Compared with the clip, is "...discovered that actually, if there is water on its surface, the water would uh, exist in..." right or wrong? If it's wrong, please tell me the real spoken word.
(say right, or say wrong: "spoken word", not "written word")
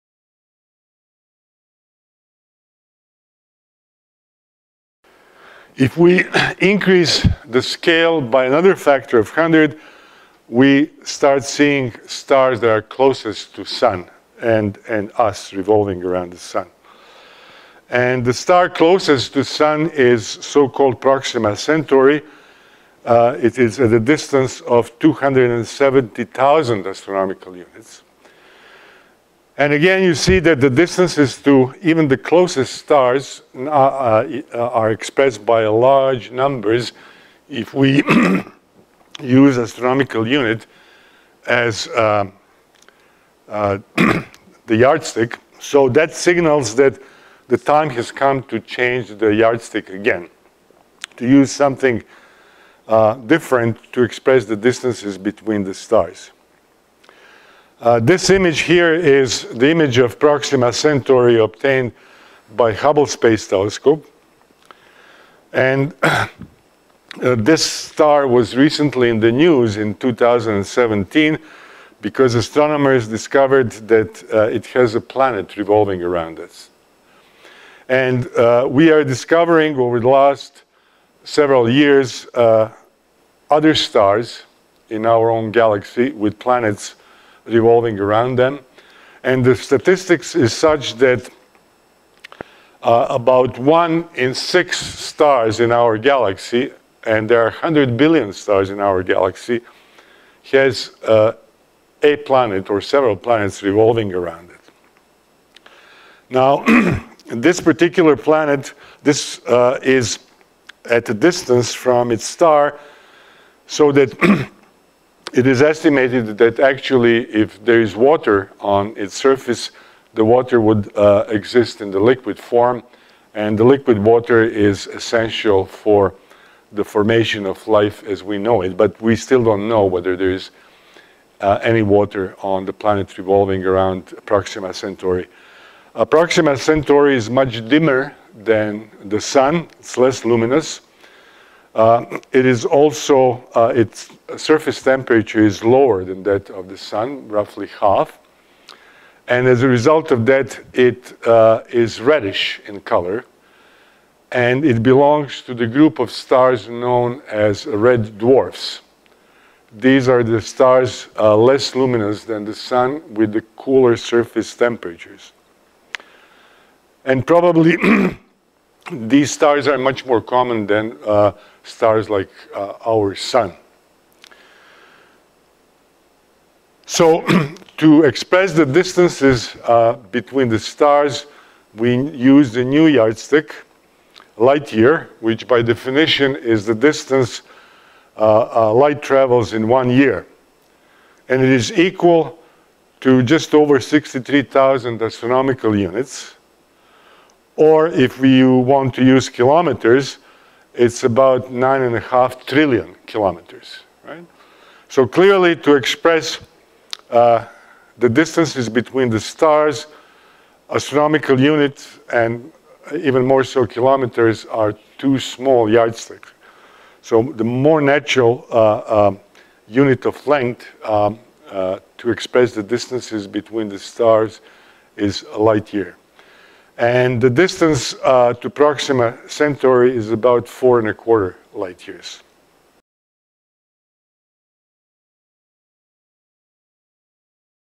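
wrong: "estimated", not "discovered".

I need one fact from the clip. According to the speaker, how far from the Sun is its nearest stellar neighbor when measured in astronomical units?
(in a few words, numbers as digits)
270,000 astronomical units.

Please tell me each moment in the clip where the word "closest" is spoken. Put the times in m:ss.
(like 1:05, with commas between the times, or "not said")
0:12, 0:18, 0:32.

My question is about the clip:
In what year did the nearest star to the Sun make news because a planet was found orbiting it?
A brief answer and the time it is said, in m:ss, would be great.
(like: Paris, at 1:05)
2017, at 1:09.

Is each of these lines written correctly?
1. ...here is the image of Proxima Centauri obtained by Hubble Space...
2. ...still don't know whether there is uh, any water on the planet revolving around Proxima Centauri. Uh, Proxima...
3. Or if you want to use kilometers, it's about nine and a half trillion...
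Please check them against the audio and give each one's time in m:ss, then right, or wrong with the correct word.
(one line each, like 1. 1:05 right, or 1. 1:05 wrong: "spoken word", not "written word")
1. 0:58 right
2. 2:09 right
3. 3:17 right.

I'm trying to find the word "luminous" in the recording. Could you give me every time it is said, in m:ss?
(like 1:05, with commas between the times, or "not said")
2:20, 2:41.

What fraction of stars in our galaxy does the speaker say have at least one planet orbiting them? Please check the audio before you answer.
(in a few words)
1 in 6.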